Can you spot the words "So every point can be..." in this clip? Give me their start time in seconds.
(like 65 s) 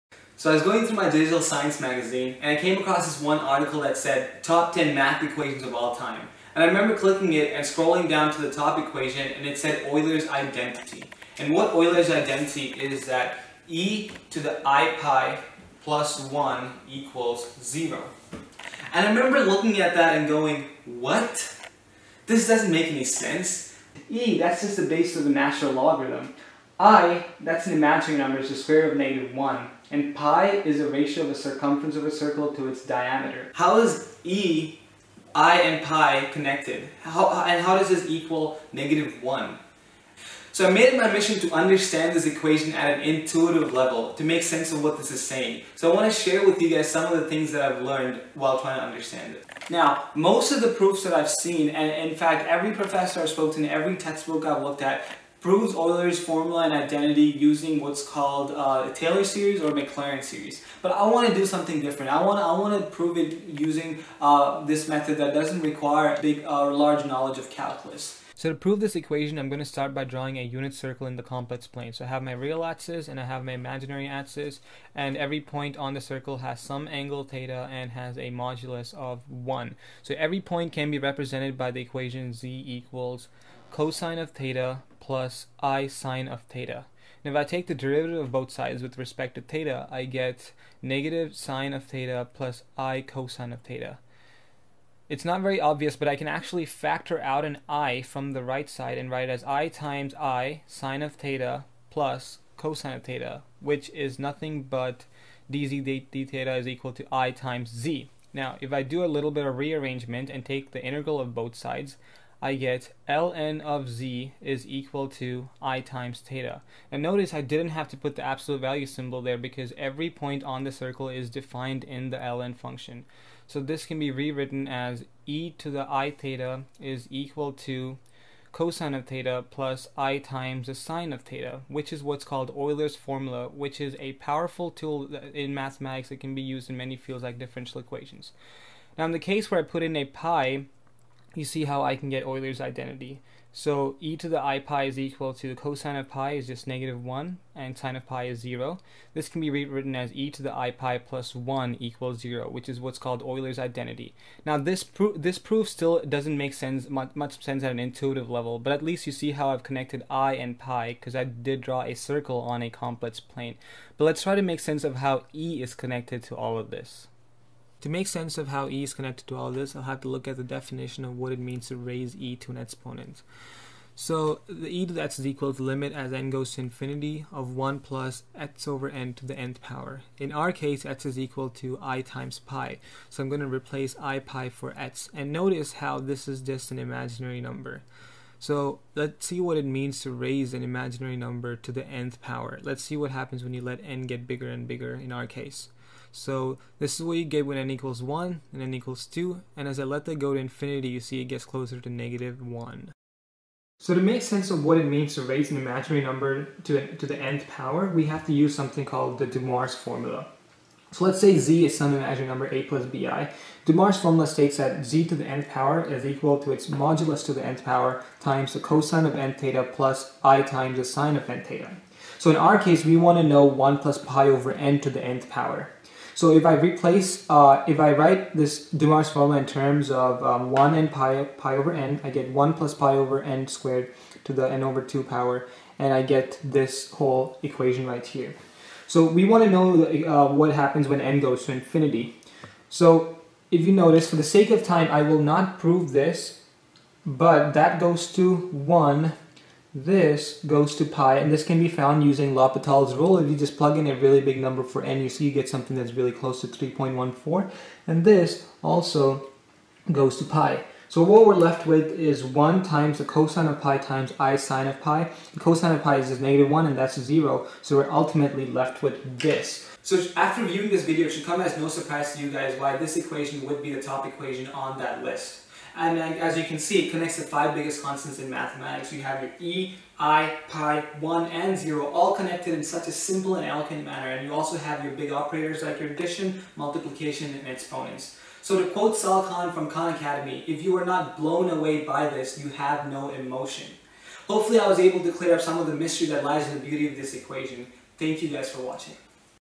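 80 s.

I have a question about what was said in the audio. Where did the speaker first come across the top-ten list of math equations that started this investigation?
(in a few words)
Digital science magazine.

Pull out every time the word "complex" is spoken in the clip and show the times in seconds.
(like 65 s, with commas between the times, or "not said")
71 s, 162 s.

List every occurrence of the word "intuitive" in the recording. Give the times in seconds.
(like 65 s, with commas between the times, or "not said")
43 s, 157 s.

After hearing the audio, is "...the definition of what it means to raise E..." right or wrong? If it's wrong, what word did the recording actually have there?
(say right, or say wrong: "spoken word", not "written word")
right.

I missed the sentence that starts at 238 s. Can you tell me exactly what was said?
So we want to know uh, what happens when n goes to infinity.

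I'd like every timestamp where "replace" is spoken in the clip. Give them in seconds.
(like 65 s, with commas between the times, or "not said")
183 s, 226 s.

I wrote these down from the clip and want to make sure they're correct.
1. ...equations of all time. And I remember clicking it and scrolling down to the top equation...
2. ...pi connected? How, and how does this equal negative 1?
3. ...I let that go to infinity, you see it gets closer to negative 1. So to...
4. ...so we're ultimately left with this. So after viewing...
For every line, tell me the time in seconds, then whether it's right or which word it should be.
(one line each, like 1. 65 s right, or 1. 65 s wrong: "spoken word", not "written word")
1. 5 s right
2. 35 s right
3. 199 s right
4. 267 s right.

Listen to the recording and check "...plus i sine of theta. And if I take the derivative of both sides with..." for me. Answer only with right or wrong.
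right.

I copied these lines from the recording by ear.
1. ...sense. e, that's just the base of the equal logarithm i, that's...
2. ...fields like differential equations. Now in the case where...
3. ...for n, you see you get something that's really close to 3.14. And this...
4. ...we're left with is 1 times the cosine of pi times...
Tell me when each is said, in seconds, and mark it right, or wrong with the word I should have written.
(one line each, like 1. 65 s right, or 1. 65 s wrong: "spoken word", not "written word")
1. 23 s wrong: "natural", not "equal"
2. 136 s right
3. 254 s right
4. 261 s right.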